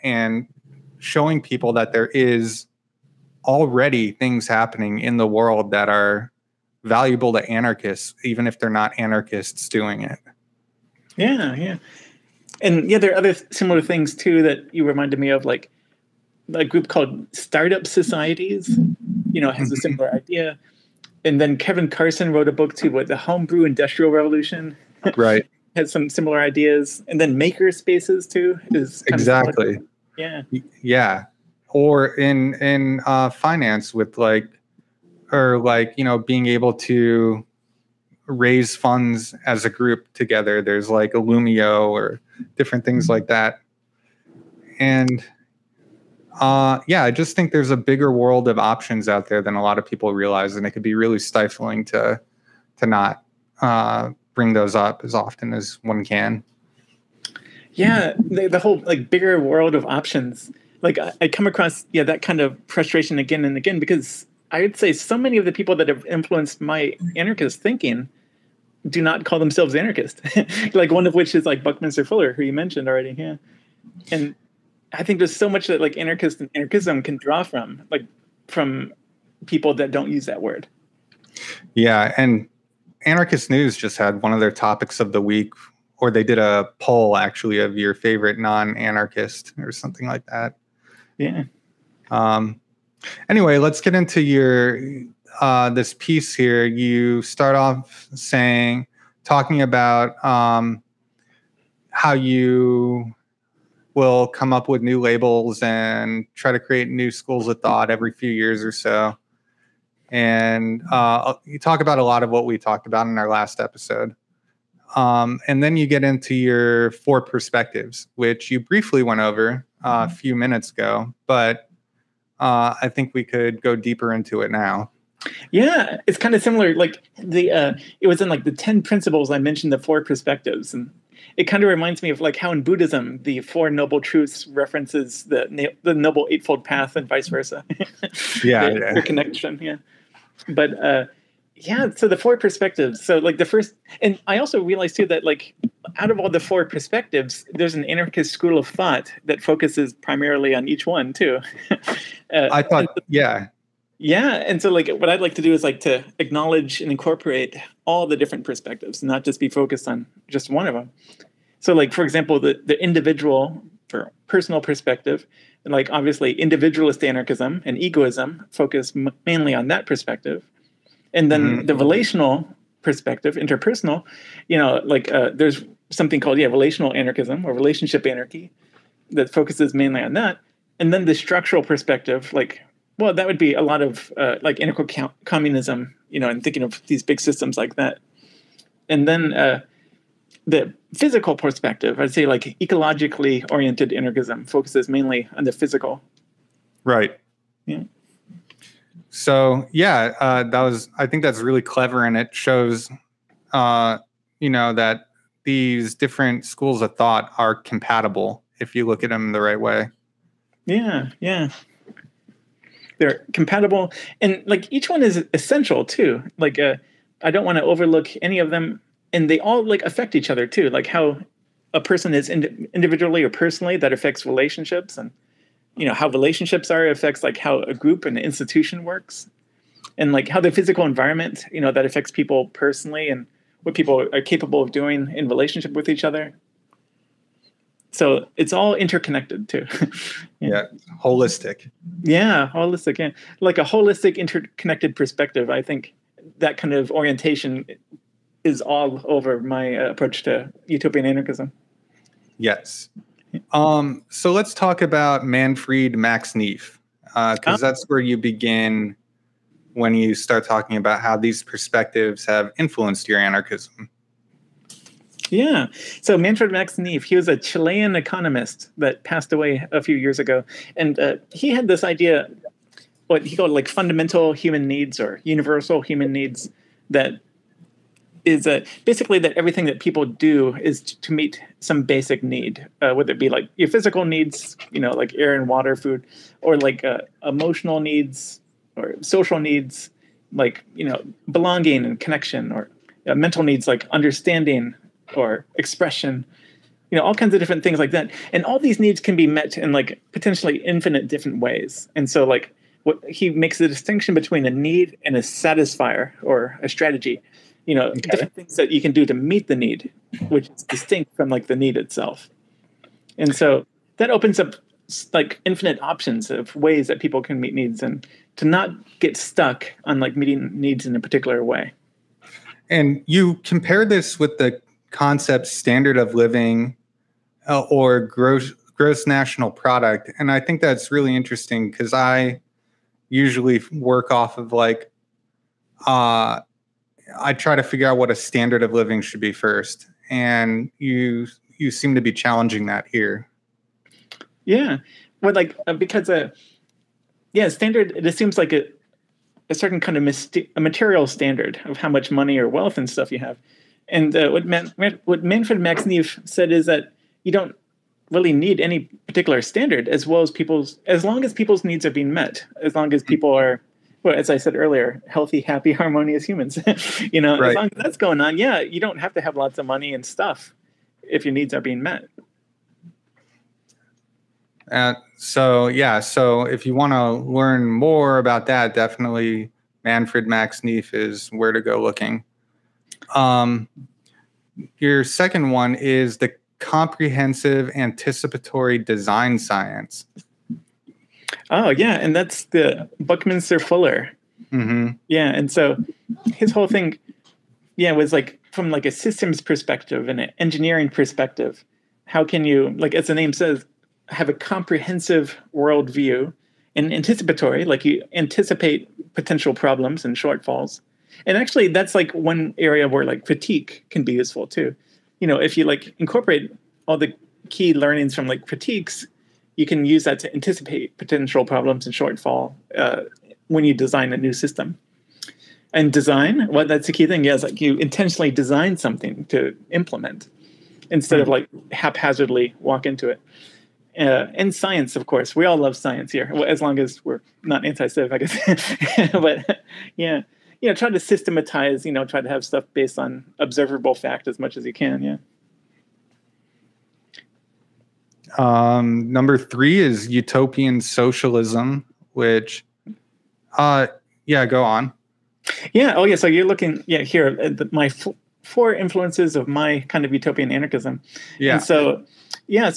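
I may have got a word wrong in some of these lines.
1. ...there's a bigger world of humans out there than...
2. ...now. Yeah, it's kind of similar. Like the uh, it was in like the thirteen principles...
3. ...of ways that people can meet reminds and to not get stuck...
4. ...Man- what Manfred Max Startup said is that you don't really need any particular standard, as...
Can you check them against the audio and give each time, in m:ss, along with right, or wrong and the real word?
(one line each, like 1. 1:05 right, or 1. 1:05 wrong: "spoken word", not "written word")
1. 0:47 wrong: "options", not "humans"
2. 2:04 wrong: "ten", not "thirteen"
3. 5:16 wrong: "needs", not "reminds"
4. 5:54 wrong: "Neef", not "Startup".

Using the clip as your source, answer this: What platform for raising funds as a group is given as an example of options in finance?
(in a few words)
Illumio.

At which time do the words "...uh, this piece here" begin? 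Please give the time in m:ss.
1:35.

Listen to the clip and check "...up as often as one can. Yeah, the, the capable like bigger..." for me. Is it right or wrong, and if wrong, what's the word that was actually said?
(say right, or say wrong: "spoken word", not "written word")
wrong: "whole", not "capable".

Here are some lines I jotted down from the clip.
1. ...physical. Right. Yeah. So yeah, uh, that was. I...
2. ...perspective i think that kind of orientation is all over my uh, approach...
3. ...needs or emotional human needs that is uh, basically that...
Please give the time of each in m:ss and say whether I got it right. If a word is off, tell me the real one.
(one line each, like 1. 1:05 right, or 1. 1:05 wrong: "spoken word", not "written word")
1. 3:15 right
2. 4:04 right
3. 4:34 wrong: "universal", not "emotional".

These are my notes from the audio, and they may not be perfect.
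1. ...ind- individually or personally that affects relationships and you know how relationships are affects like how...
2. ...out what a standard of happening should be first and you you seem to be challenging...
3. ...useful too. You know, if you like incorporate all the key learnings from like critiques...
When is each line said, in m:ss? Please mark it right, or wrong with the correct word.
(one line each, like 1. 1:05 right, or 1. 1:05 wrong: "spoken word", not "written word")
1. 3:42 right
2. 5:37 wrong: "living", not "happening"
3. 6:54 right.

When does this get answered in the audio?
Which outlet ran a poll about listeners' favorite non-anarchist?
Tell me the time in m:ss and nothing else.
1:23.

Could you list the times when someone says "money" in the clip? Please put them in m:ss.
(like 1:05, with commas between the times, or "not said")
5:52, 6:09.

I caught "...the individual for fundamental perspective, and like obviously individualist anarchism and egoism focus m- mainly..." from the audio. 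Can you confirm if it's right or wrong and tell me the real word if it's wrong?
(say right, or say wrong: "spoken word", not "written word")
wrong: "personal", not "fundamental".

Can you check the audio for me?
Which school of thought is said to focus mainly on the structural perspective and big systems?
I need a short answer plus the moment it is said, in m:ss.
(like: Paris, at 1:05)
Integral communism, at 3:04.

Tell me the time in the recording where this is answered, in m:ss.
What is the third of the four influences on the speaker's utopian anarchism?
7:30.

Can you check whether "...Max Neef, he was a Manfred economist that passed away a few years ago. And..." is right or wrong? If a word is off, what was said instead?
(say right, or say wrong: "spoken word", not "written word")
wrong: "Chilean", not "Manfred".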